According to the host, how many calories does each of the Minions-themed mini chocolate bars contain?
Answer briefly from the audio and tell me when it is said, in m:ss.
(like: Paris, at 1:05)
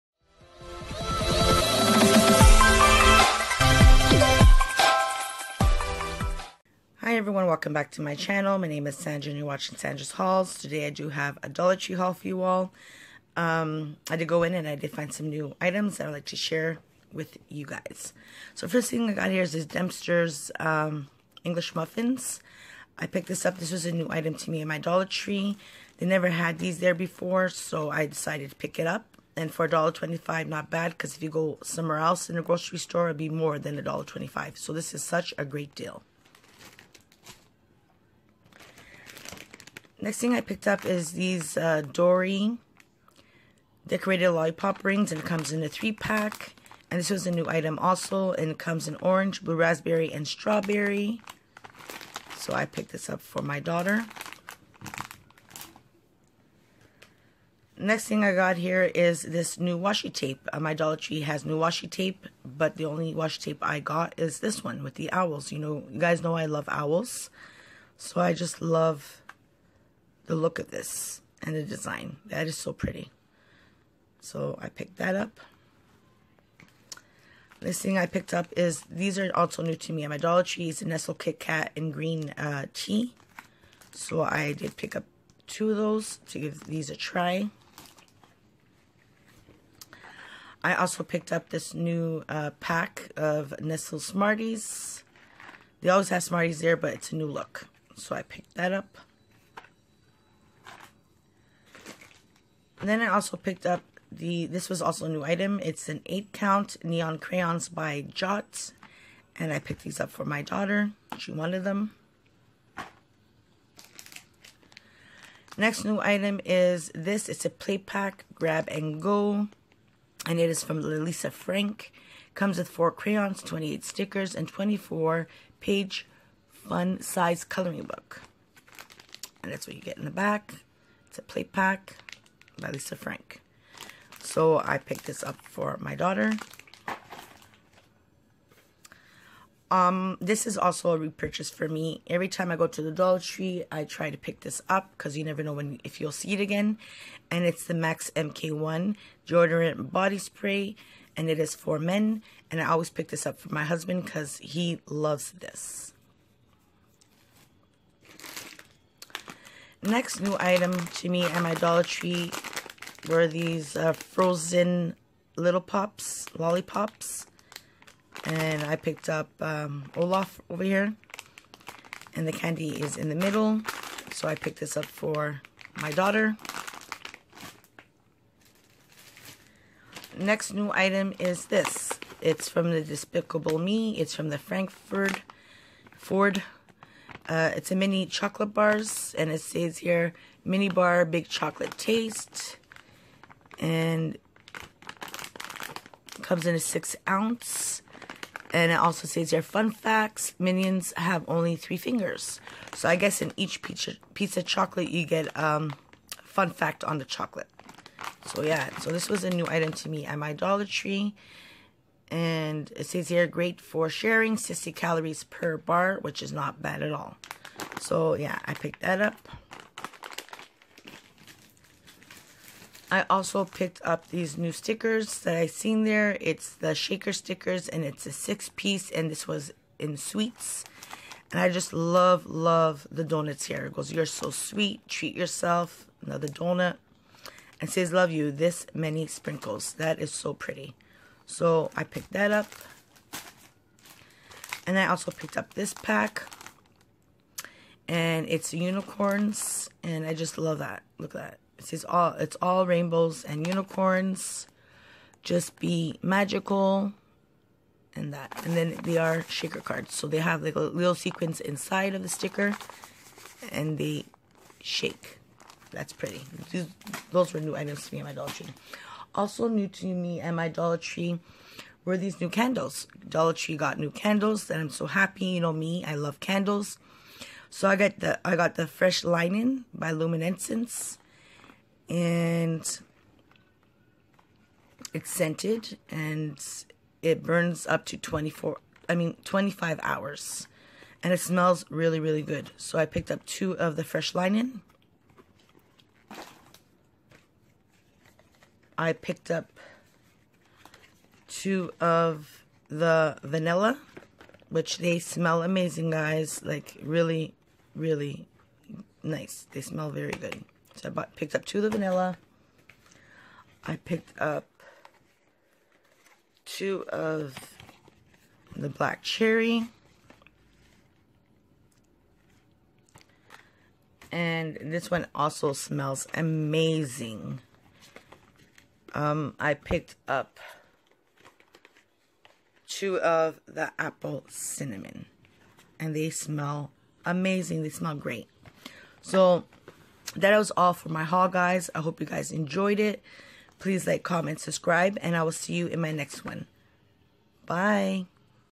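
60, at 3:34.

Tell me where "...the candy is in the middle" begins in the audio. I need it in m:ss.
2:52.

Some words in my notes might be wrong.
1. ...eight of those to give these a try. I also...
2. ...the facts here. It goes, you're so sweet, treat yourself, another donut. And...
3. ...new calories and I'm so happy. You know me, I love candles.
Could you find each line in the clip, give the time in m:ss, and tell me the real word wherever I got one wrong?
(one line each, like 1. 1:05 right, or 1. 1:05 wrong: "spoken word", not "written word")
1. 1:25 wrong: "two", not "eight"
2. 3:52 wrong: "donuts", not "facts"
3. 4:33 wrong: "candles", not "calories".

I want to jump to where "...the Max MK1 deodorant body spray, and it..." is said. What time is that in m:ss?
2:27.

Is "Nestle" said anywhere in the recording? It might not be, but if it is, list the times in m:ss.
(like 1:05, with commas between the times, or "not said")
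1:20, 1:33.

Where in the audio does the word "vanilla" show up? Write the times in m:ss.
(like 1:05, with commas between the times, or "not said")
5:03, 5:11.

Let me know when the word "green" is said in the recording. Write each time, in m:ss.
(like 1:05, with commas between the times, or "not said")
1:21.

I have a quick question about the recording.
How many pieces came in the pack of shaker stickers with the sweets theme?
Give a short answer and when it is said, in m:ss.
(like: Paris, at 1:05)
6, at 3:48.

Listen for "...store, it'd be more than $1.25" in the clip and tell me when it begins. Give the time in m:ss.
0:32.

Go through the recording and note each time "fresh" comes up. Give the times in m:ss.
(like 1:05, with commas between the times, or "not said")
4:38, 4:53.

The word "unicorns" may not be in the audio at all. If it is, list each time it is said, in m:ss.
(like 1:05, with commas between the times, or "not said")
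4:08, 4:13.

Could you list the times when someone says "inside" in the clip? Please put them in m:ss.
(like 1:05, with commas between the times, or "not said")
4:21.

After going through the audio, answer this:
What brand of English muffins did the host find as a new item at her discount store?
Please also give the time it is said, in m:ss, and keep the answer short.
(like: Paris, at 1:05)
Dempster's, at 0:19.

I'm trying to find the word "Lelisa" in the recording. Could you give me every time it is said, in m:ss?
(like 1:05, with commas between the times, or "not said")
2:00.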